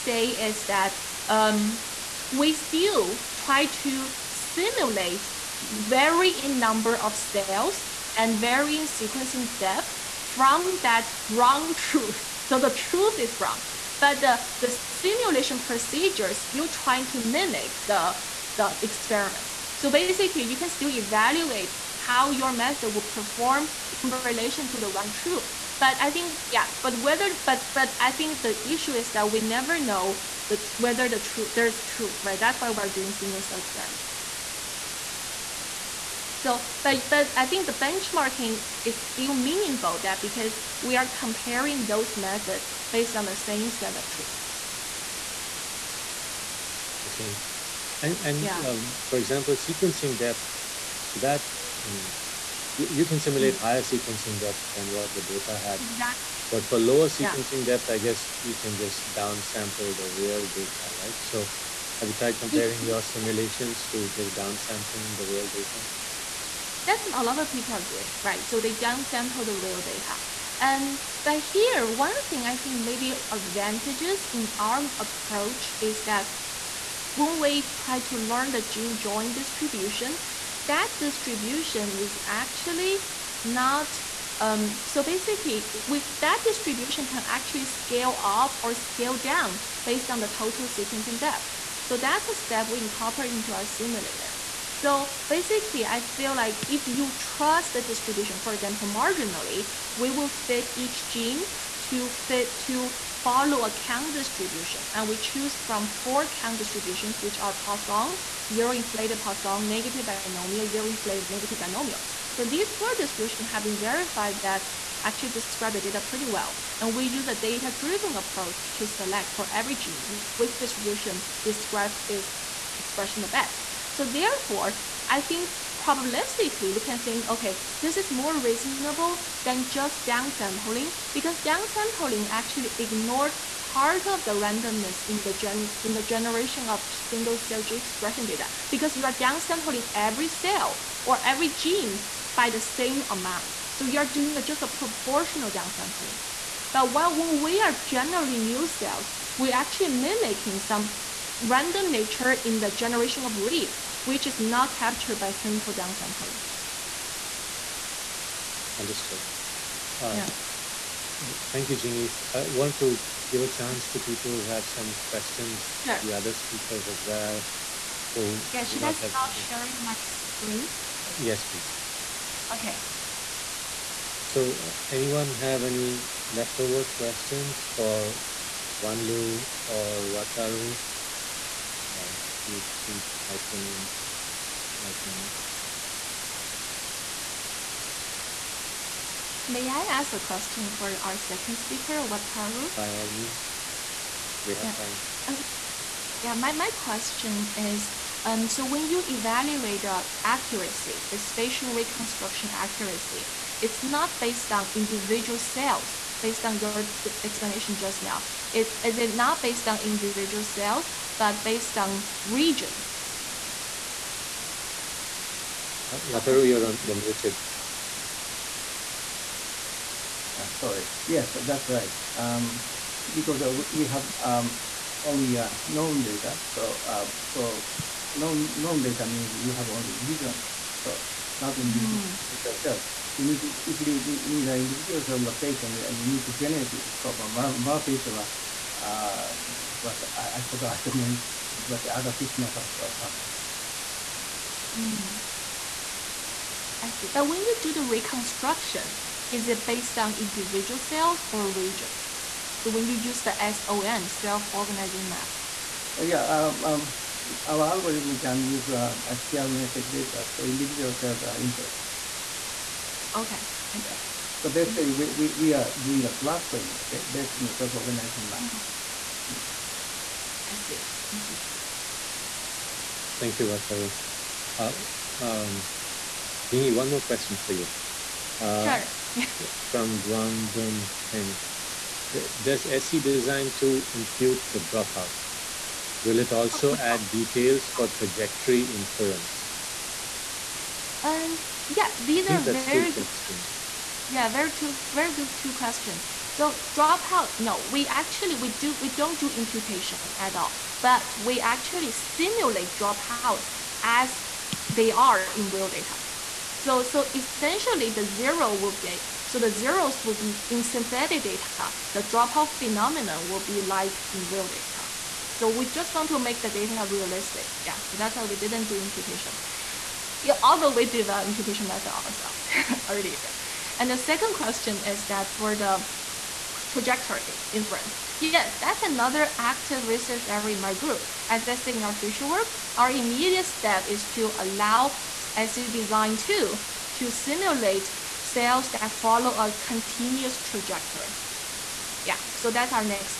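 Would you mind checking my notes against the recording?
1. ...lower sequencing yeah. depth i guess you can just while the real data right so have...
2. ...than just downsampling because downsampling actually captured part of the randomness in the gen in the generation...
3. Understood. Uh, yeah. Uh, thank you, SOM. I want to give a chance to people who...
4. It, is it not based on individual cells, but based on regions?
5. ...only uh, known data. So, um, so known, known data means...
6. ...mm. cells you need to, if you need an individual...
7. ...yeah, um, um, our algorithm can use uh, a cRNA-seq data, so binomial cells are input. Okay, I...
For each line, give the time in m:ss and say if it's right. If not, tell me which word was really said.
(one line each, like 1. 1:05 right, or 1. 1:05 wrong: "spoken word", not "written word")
1. 0:56 wrong: "downsample", not "while"
2. 2:09 wrong: "ignored", not "captured"
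3. 2:38 wrong: "Jingyi", not "SOM"
4. 3:28 right
5. 3:45 right
6. 3:52 right
7. 4:16 wrong: "individual", not "binomial".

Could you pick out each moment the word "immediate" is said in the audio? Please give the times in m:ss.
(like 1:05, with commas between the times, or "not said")
5:32.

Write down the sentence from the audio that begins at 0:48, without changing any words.
um, for example sequencing depth so that you know you, you can simulate mm-hmm.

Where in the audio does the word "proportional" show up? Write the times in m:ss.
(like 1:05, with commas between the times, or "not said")
2:24.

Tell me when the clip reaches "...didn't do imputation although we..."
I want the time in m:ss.
5:18.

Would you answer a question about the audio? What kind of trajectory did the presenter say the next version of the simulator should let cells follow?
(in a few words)
Continuous trajectory.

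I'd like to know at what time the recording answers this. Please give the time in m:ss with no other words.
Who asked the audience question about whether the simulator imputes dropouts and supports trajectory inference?
4:39.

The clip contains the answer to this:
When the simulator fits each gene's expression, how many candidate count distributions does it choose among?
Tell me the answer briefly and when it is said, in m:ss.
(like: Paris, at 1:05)
4, at 1:45.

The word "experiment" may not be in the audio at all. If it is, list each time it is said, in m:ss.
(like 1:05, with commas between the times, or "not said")
0:18, 0:33.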